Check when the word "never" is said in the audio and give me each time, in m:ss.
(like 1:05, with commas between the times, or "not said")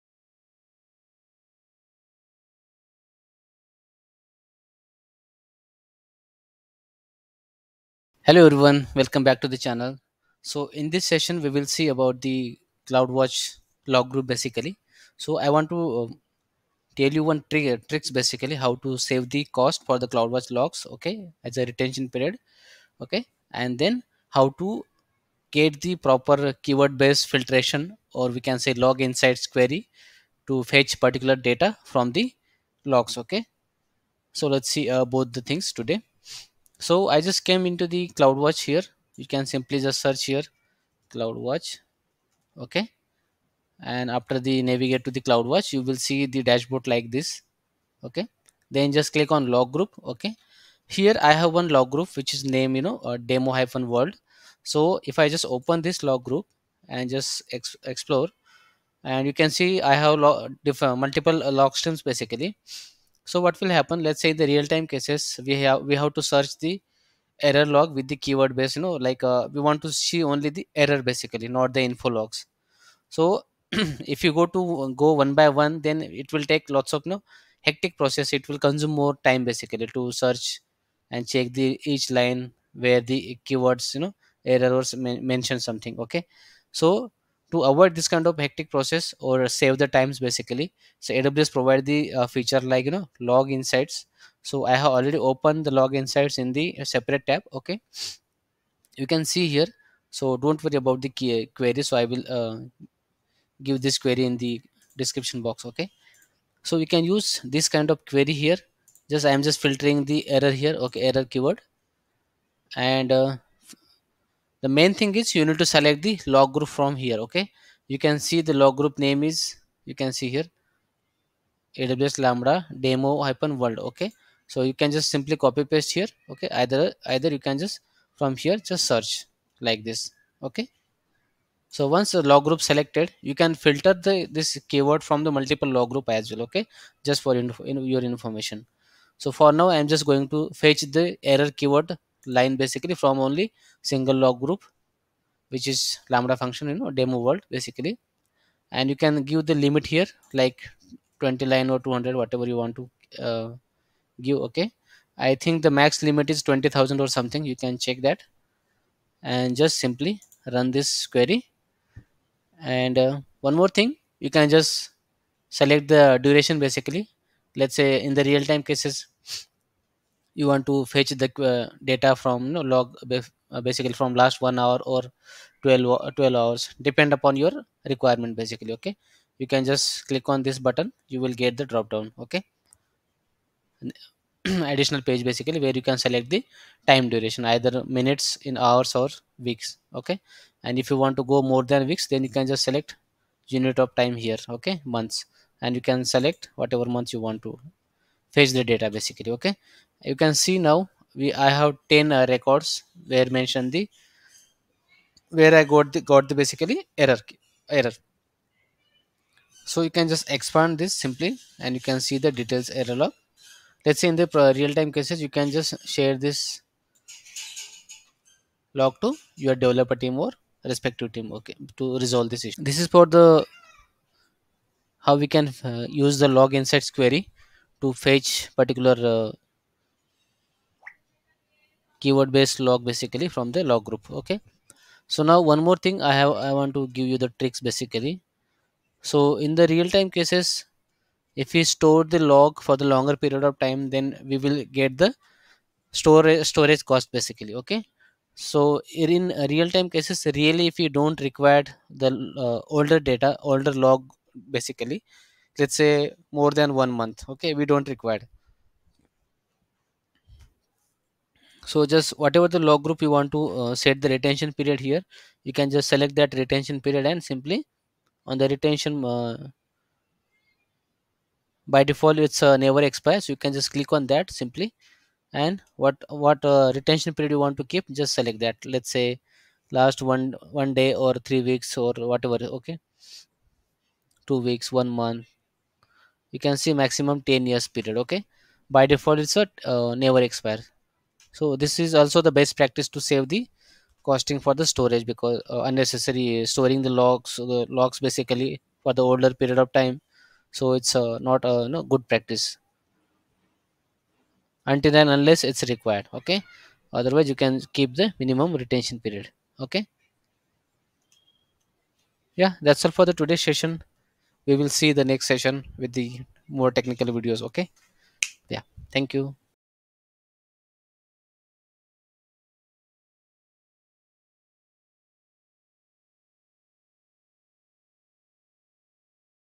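4:32, 4:49.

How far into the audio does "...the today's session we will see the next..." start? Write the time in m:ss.
5:13.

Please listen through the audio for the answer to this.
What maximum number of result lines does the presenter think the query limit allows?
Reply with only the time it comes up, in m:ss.
2:36.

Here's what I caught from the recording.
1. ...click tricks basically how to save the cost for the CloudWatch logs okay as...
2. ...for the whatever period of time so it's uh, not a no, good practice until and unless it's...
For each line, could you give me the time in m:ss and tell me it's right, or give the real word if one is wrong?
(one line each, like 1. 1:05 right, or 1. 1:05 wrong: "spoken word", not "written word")
1. 0:17 wrong: "trick", not "click"
2. 4:58 wrong: "older", not "whatever".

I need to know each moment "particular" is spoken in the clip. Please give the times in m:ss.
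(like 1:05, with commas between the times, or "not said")
0:31, 3:48.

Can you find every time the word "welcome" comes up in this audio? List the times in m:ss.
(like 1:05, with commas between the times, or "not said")
0:08.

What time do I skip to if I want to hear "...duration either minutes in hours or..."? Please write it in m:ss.
3:07.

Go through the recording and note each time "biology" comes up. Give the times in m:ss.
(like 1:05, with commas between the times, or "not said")
not said.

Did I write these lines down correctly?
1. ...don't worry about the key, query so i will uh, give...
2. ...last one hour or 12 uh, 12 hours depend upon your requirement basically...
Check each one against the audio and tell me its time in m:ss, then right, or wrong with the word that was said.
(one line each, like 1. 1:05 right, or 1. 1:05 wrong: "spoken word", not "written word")
1. 1:40 right
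2. 2:54 right.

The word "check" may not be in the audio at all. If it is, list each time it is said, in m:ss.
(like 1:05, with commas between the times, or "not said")
1:21, 2:37.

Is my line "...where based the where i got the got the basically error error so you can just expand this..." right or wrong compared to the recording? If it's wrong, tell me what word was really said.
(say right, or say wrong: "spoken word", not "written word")
wrong: "mentioned", not "based".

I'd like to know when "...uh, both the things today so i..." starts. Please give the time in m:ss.
0:34.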